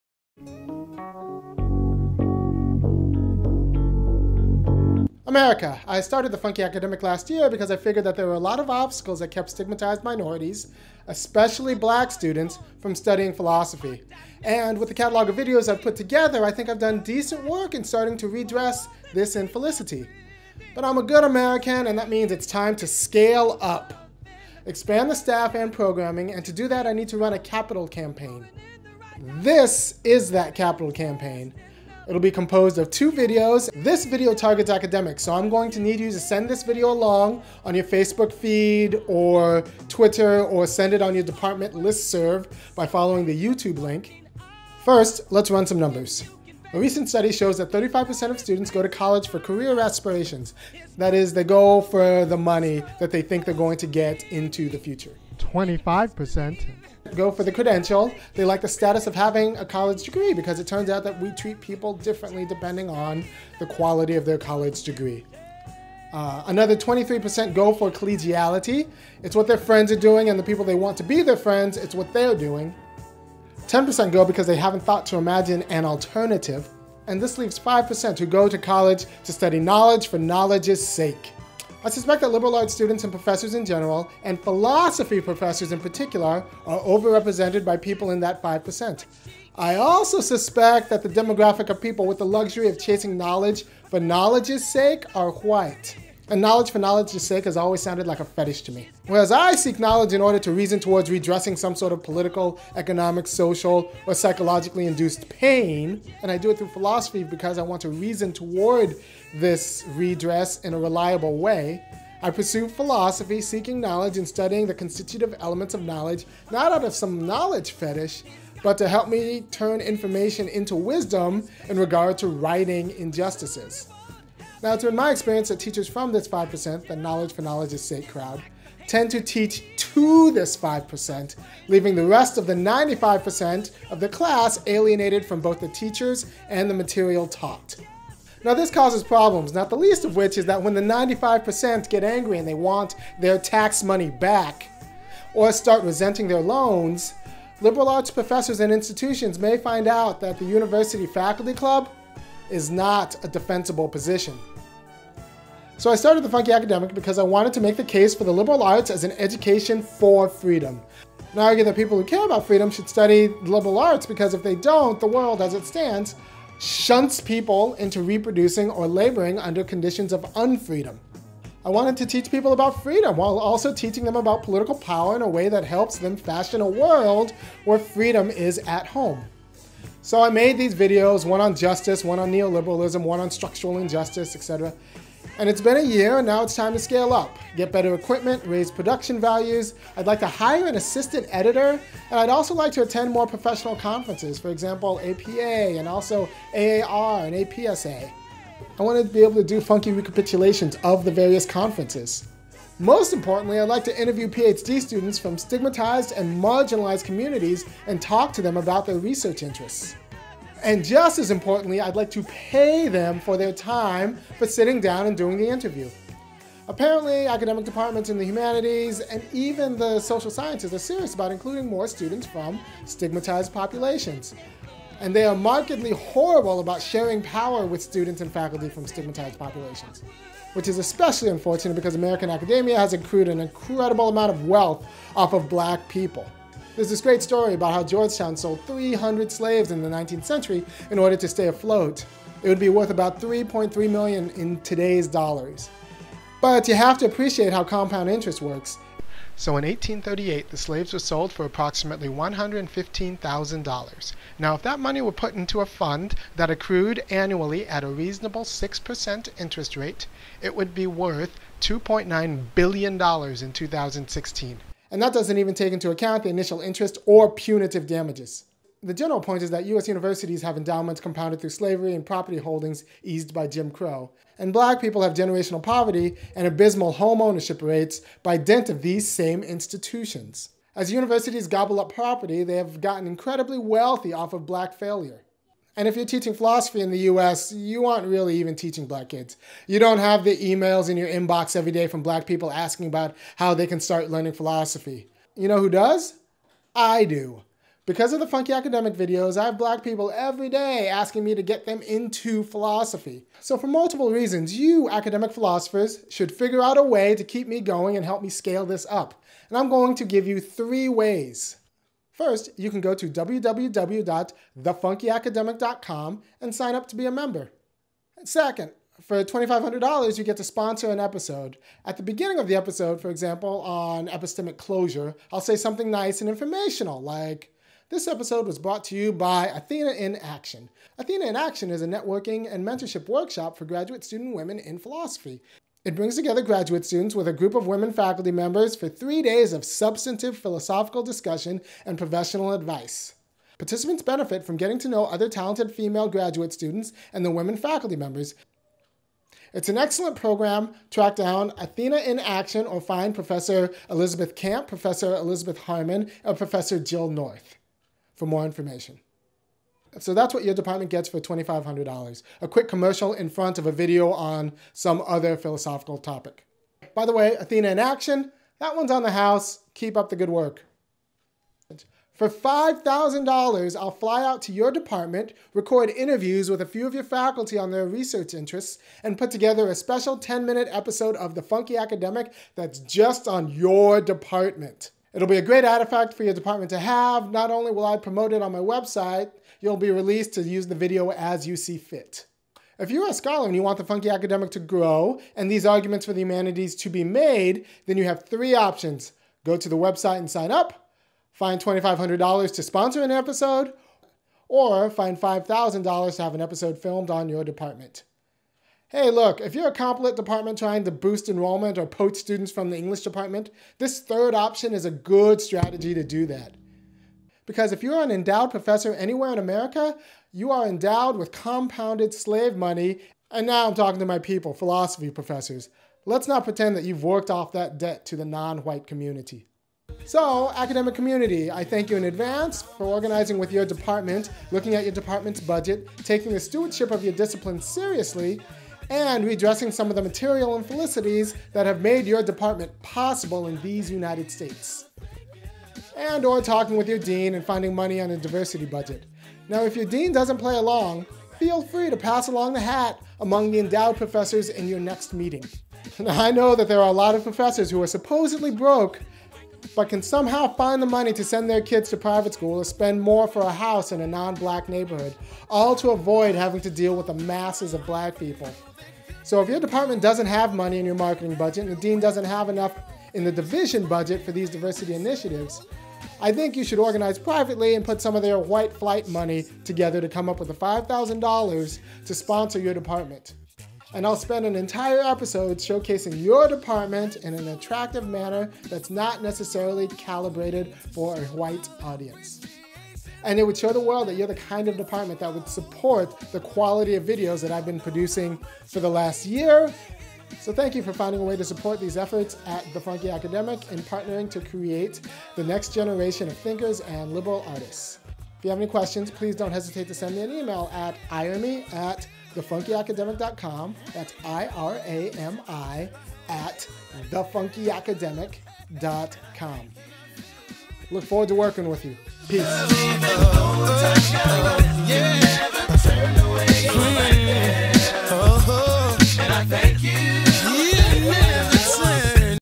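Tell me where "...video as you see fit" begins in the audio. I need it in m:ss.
6:30.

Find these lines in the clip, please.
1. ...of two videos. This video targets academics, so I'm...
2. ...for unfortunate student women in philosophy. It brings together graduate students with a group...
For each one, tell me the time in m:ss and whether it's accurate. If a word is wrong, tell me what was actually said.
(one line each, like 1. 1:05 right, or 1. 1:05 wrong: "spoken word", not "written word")
1. 0:32 right
2. 5:33 wrong: "graduate", not "unfortunate".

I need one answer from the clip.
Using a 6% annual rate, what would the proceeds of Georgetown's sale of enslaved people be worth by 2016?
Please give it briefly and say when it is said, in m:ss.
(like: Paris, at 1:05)
$2.9 billion, at 4:21.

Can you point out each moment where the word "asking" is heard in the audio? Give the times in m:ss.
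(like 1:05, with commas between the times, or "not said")
4:52, 5:00.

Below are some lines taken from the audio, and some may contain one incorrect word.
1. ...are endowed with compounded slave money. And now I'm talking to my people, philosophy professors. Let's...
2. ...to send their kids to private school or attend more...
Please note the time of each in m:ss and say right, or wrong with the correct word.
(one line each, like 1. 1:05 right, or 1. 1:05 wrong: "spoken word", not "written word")
1. 7:00 right
2. 7:41 wrong: "spend", not "attend".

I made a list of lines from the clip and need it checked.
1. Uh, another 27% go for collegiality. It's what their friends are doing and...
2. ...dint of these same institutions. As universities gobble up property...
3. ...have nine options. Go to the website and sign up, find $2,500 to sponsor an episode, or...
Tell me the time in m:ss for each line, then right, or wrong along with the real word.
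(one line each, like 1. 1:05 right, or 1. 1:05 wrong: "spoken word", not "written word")
1. 1:06 wrong: "23", not "27"
2. 4:38 right
3. 6:38 wrong: "three", not "nine".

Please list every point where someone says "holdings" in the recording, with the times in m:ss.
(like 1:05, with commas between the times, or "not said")
4:32.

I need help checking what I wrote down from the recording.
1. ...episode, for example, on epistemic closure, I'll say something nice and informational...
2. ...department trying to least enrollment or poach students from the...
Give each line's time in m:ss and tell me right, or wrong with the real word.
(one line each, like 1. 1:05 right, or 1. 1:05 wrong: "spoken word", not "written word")
1. 5:22 right
2. 6:50 wrong: "boost", not "least".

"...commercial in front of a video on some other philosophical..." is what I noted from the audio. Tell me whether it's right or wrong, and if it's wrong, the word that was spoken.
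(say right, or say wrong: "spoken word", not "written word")
right.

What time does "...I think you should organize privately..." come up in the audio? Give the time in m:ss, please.
7:56.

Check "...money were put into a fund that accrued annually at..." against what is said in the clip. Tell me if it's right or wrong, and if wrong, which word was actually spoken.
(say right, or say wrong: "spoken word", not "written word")
right.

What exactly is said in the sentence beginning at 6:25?
It'll be a great artifact for your department to have.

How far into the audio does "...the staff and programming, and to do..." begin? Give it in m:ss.
0:25.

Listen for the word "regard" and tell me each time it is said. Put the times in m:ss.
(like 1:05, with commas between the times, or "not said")
2:01.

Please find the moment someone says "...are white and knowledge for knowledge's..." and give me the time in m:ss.
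1:35.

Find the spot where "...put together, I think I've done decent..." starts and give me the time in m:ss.
0:15.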